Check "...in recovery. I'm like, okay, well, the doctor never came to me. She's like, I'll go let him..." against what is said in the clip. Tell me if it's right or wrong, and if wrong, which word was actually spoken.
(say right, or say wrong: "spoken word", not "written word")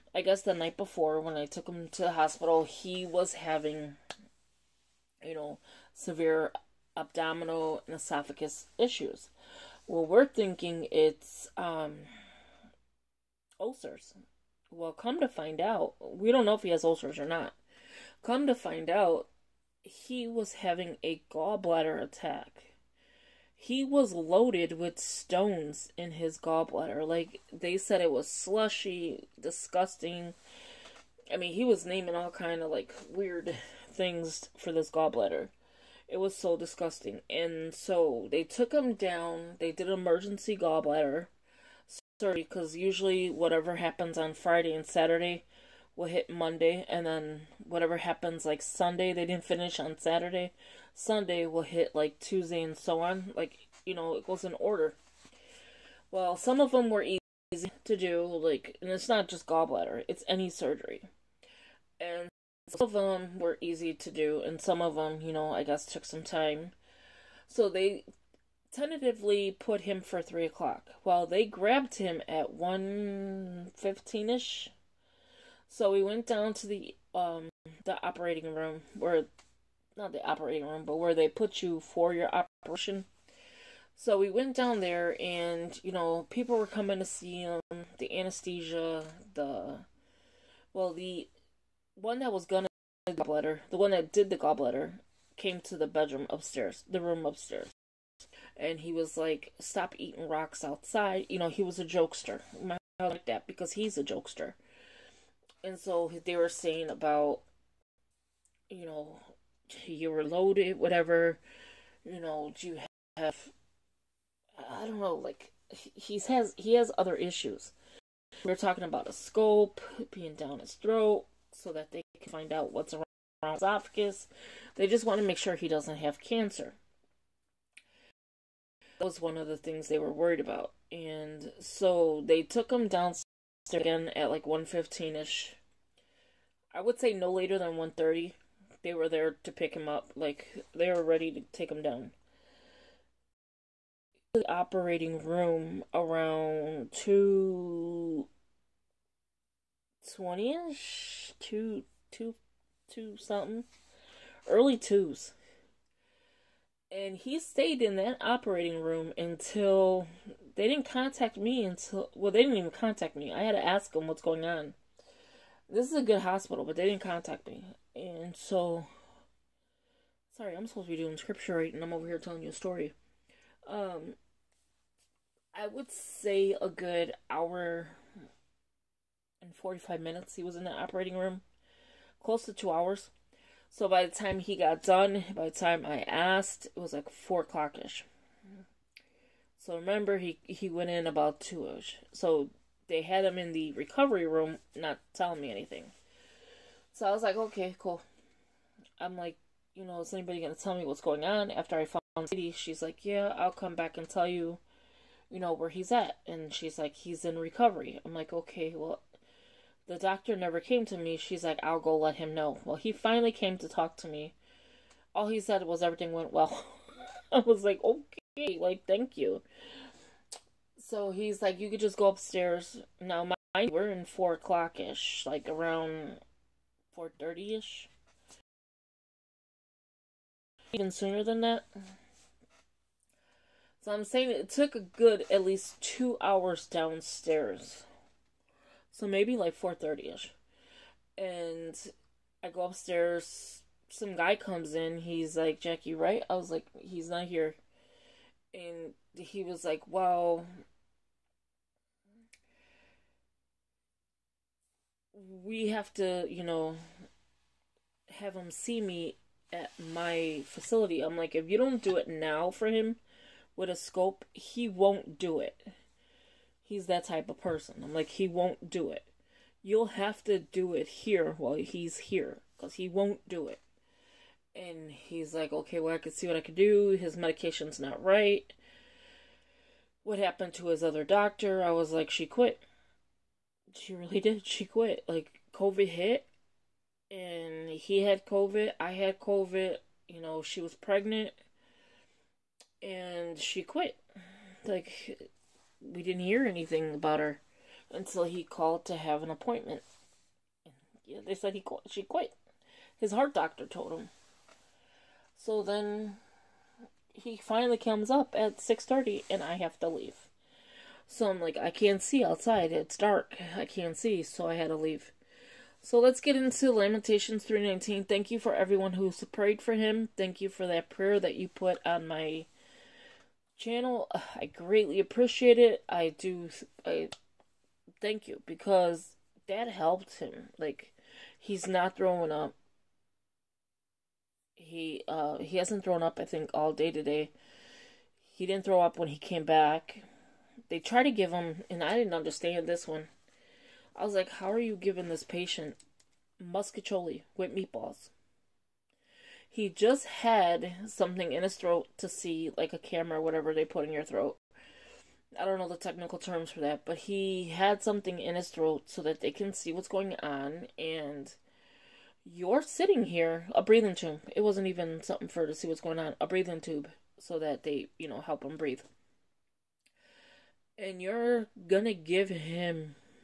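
right.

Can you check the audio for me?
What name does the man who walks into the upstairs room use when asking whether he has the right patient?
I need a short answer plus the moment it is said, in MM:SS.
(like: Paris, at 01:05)
Jackie, at 04:05.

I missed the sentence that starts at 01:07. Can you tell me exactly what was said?
So they tentatively put him for three o'clock.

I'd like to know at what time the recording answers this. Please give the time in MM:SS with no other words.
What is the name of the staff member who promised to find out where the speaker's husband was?
03:22.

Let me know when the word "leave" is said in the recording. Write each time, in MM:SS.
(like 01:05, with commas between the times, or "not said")
05:09, 05:14.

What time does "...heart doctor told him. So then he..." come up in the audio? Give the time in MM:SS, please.
05:03.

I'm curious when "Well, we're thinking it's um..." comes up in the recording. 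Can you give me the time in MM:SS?
00:09.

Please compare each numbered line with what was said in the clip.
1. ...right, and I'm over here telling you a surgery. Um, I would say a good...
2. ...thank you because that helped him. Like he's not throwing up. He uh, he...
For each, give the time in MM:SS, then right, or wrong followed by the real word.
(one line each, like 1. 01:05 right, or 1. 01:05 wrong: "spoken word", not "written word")
1. 02:51 wrong: "story", not "surgery"
2. 05:28 right.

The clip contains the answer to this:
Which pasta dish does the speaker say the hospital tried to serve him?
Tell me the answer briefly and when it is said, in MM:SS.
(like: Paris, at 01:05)
mostaccioli with meatballs, at 05:46.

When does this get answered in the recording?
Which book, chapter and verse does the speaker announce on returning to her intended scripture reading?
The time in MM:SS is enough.
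05:16.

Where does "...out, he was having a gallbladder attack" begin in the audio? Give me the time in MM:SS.
00:18.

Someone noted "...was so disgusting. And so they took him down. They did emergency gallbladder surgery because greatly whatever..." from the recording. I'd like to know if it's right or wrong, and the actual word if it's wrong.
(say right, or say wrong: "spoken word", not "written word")
wrong: "usually", not "greatly".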